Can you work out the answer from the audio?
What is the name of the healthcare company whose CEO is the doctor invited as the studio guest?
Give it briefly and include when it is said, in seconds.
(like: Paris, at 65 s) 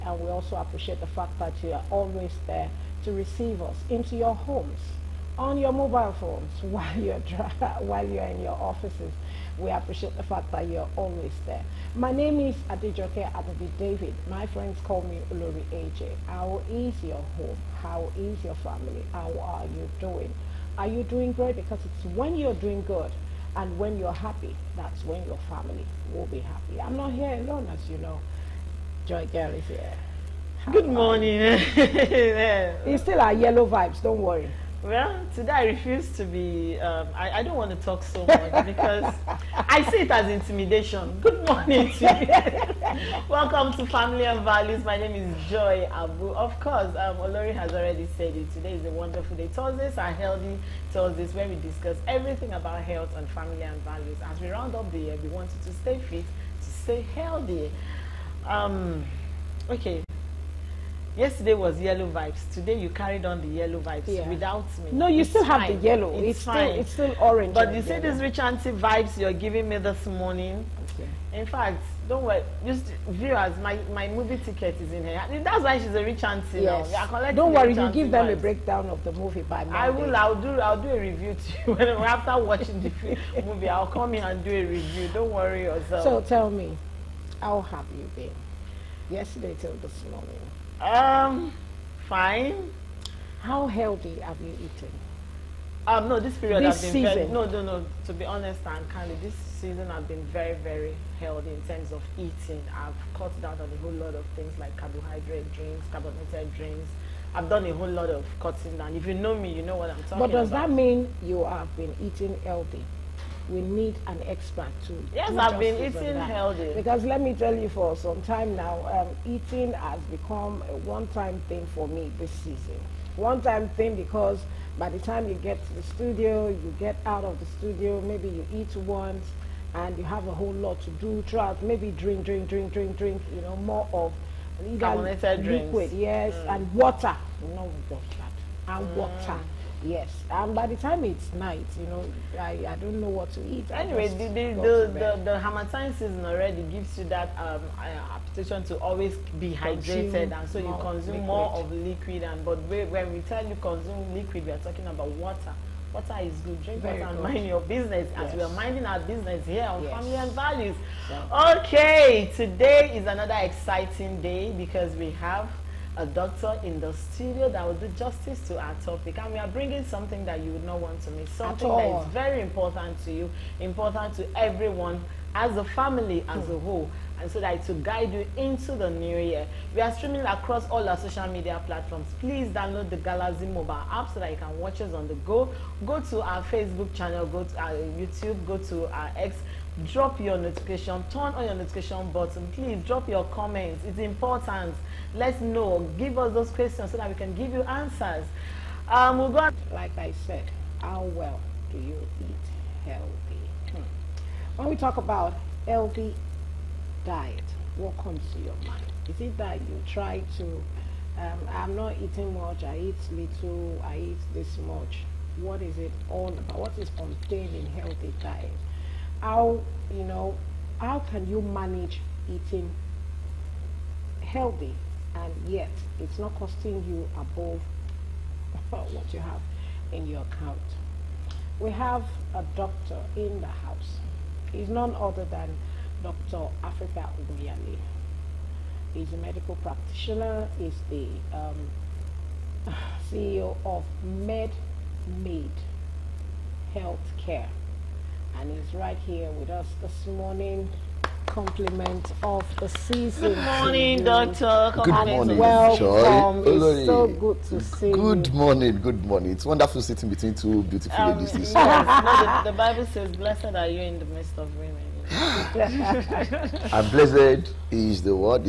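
MedMade Healthcare, at 244 s.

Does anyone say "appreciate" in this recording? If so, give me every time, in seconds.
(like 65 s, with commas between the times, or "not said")
0 s, 9 s.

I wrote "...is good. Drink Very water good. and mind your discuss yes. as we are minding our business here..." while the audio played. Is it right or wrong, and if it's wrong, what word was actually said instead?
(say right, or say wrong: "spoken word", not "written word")
wrong: "business", not "discuss".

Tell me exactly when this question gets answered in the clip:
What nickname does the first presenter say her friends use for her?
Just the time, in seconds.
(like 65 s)
15 s.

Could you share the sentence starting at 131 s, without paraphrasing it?
Maybe drink, drink, drink, drink, drink.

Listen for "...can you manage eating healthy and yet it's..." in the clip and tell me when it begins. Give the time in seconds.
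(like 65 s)
221 s.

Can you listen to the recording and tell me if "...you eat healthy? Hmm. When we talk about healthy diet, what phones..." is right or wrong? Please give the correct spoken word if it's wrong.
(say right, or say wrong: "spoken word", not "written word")
wrong: "comes", not "phones".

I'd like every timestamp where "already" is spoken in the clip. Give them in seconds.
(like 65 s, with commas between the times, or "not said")
47 s, 146 s.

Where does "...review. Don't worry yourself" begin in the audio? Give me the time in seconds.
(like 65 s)
84 s.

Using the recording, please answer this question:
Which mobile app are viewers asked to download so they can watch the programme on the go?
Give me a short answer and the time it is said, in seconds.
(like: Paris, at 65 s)
Galaxy mobile app, at 182 s.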